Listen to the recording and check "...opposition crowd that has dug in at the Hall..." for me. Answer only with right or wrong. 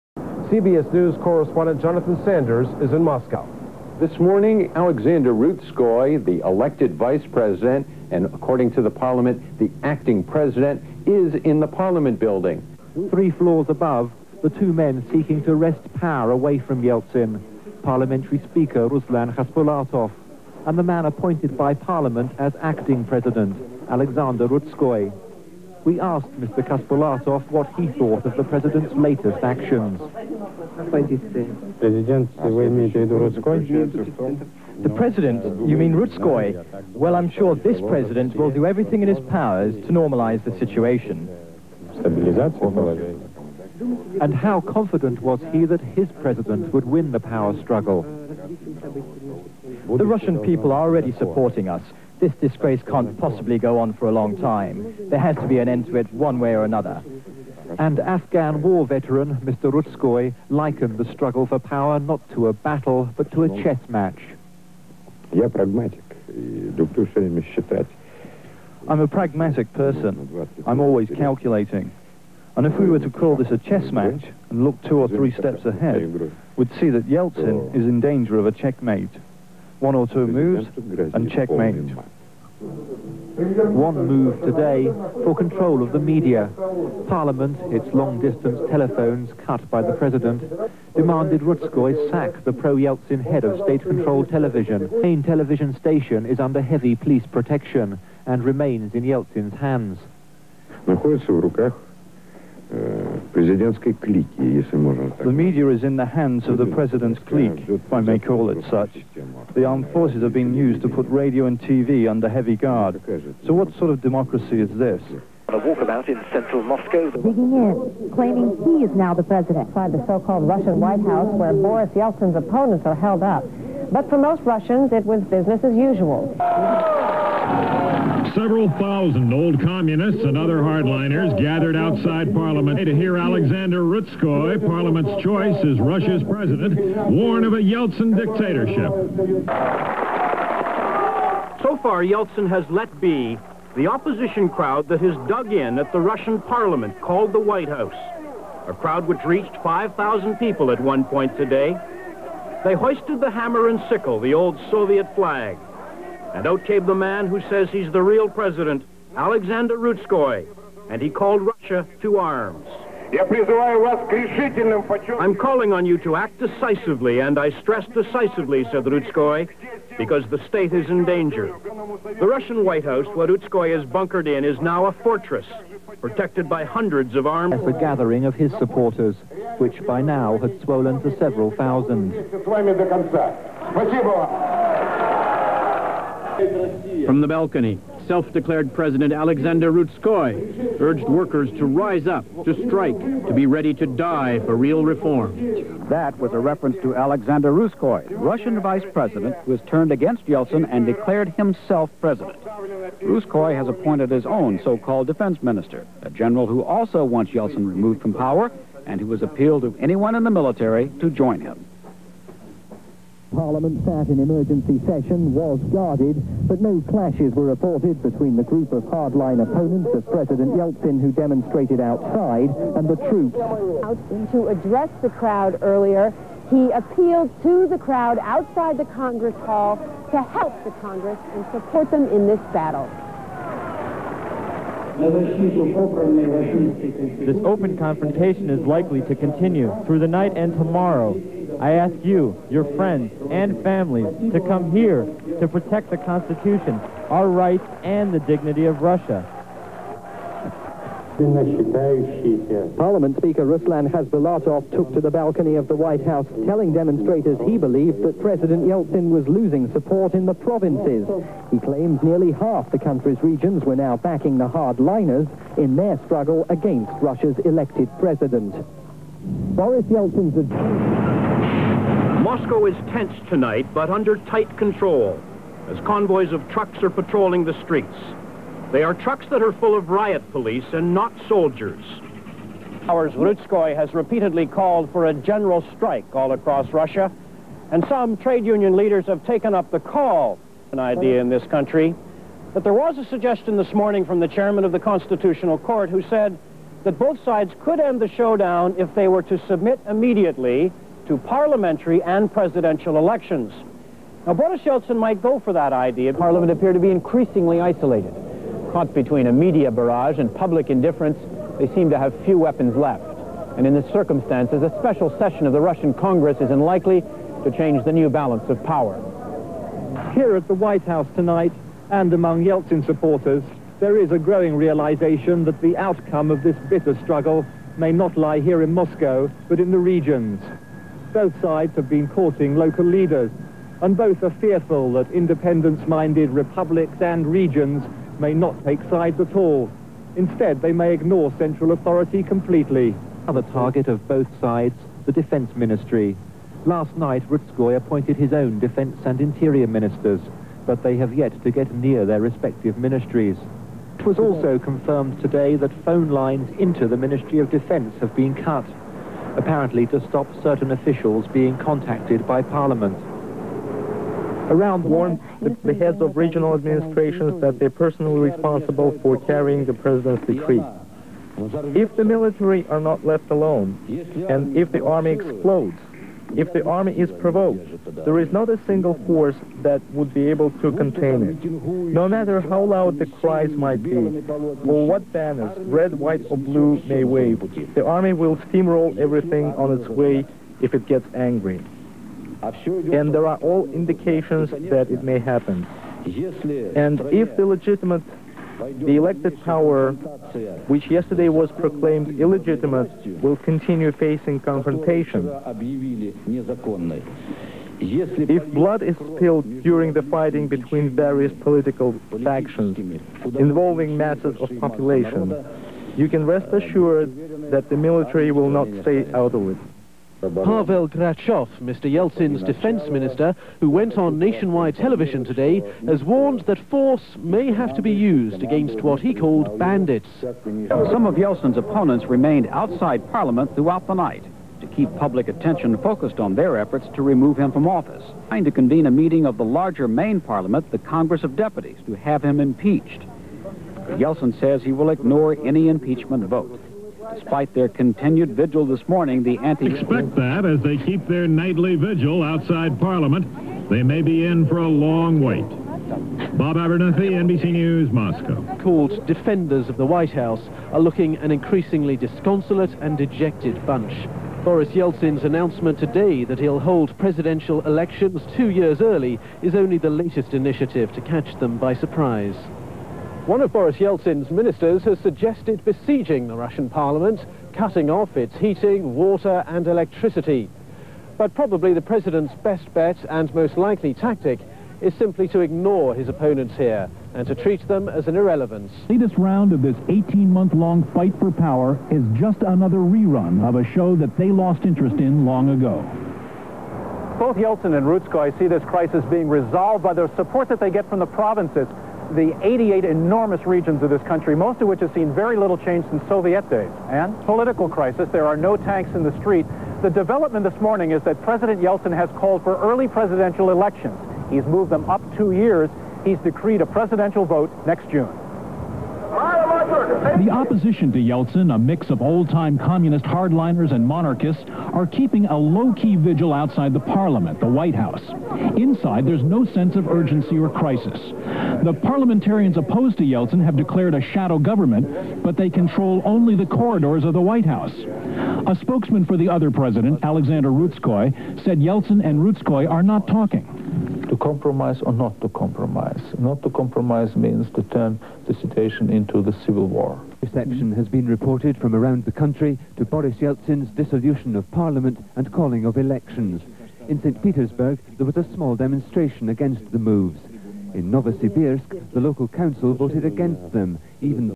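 wrong.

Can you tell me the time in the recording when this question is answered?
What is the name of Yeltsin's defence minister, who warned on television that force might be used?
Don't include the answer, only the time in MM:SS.
07:00.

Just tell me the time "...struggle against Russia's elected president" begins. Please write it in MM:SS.
04:26.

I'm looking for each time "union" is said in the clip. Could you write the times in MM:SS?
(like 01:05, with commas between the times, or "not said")
04:48.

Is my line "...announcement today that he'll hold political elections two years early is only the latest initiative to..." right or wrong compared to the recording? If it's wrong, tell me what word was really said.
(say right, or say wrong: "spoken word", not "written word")
wrong: "presidential", not "political".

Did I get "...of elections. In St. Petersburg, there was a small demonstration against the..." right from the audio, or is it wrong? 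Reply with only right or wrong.
right.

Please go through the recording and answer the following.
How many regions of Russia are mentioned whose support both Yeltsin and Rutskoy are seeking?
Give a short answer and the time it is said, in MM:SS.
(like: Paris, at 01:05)
88, at 08:22.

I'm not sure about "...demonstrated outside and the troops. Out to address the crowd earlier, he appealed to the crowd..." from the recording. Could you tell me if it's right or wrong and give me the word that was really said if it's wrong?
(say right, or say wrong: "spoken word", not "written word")
right.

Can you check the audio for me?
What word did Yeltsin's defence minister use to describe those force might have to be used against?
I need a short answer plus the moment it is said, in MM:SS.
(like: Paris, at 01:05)
Bandits, at 07:09.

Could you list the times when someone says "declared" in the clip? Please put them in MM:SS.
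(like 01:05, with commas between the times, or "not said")
03:08, 03:20, 08:53.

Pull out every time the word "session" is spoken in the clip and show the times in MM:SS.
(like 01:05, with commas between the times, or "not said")
03:34, 05:15.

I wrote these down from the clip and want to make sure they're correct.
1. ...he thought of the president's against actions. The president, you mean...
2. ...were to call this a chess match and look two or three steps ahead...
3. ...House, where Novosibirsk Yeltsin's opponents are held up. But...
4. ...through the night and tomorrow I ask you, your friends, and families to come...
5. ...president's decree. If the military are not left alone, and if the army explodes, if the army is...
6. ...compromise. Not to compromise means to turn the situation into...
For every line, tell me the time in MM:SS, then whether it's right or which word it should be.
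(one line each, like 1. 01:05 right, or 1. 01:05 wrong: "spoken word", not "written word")
1. 00:27 wrong: "latest", not "against"
2. 01:12 right
3. 02:01 wrong: "Boris", not "Novosibirsk"
4. 03:59 right
5. 06:09 right
6. 09:05 right.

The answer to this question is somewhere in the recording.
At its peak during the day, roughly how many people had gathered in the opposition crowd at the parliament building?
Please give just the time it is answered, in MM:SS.
02:29.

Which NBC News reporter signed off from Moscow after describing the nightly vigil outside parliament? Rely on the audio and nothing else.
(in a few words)
Bob Abernethy.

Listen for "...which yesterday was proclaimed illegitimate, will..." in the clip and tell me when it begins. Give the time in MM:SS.
06:40.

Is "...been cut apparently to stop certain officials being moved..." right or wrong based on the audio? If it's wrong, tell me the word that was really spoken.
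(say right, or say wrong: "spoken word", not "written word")
wrong: "contacted", not "moved".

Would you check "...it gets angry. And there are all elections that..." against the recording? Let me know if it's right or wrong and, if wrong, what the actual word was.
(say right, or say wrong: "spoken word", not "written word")
wrong: "indications", not "elections".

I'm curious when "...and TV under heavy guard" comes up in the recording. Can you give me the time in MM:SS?
01:51.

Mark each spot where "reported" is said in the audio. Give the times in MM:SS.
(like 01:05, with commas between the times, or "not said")
03:37, 09:11.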